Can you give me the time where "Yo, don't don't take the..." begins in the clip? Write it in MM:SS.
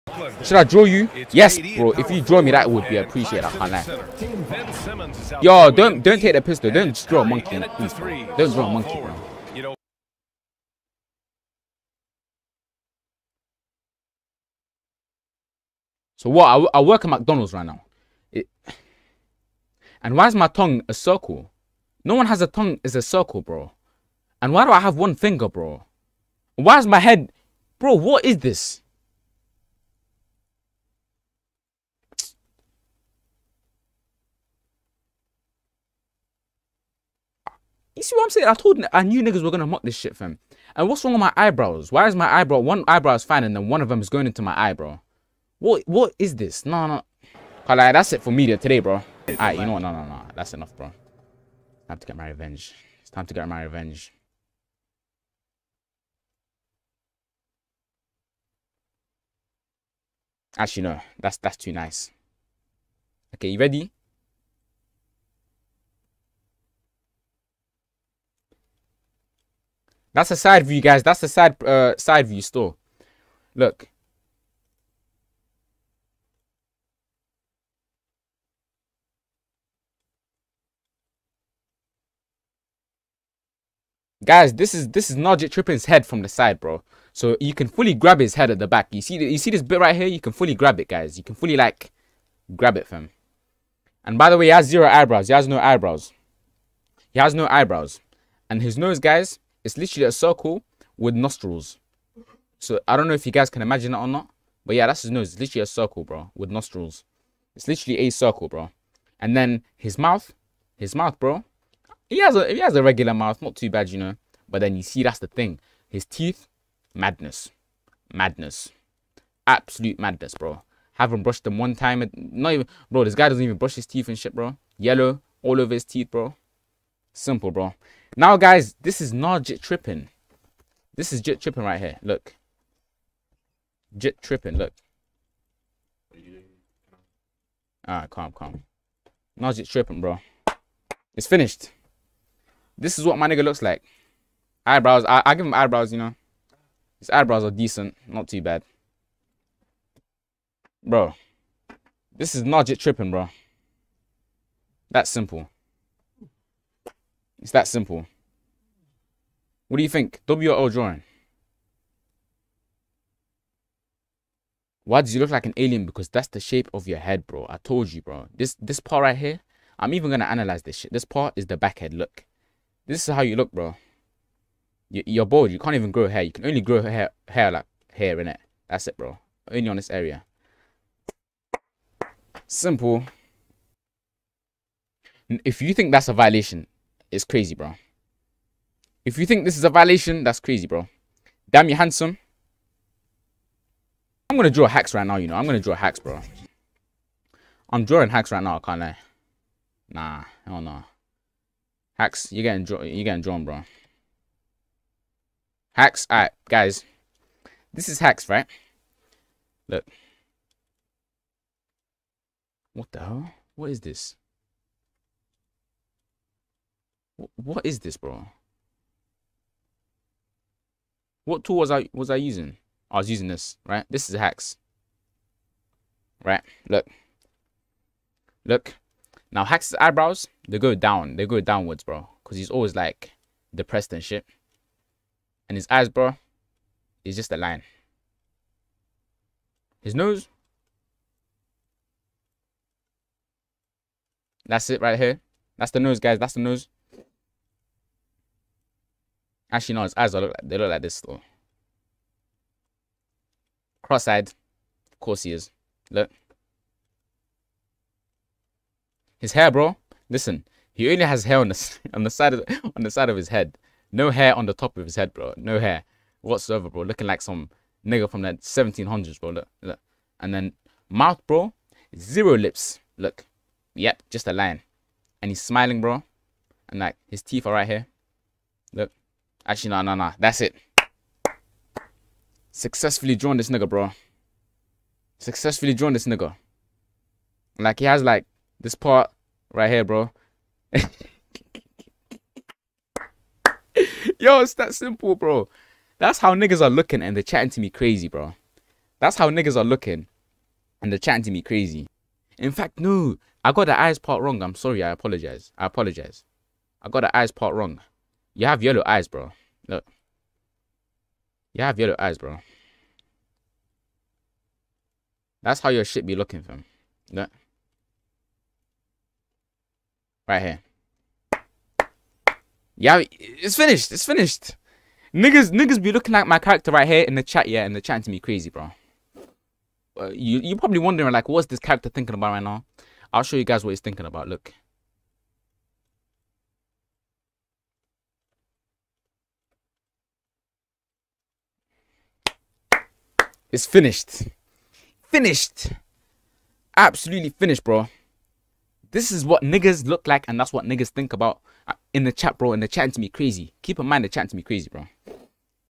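00:05.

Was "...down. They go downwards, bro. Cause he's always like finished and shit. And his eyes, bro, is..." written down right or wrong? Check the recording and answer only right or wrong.
wrong.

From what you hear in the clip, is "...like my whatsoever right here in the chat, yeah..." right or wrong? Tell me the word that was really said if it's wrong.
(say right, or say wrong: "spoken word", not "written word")
wrong: "character", not "whatsoever".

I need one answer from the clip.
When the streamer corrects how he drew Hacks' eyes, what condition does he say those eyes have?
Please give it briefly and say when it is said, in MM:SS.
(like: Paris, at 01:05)
Cross-eyed, at 04:13.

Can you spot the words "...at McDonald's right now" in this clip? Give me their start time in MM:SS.
00:17.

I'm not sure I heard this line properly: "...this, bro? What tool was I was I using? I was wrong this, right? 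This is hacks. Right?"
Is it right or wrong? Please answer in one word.
wrong.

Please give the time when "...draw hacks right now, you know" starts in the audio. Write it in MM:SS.
03:14.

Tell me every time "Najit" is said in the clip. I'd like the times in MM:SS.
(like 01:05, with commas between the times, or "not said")
01:25.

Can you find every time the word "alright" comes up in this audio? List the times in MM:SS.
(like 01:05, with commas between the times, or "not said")
00:49, 02:17, 03:26.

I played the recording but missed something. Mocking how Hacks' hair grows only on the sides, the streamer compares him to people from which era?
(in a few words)
1700s.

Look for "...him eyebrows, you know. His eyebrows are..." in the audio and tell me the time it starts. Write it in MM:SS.
02:25.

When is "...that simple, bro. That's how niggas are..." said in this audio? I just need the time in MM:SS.
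04:54.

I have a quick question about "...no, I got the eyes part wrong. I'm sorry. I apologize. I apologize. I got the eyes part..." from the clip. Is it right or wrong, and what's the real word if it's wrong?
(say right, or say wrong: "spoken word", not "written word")
right.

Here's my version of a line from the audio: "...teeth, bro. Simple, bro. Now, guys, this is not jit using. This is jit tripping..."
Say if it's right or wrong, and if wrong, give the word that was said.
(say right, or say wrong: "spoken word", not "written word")
wrong: "tripping", not "using".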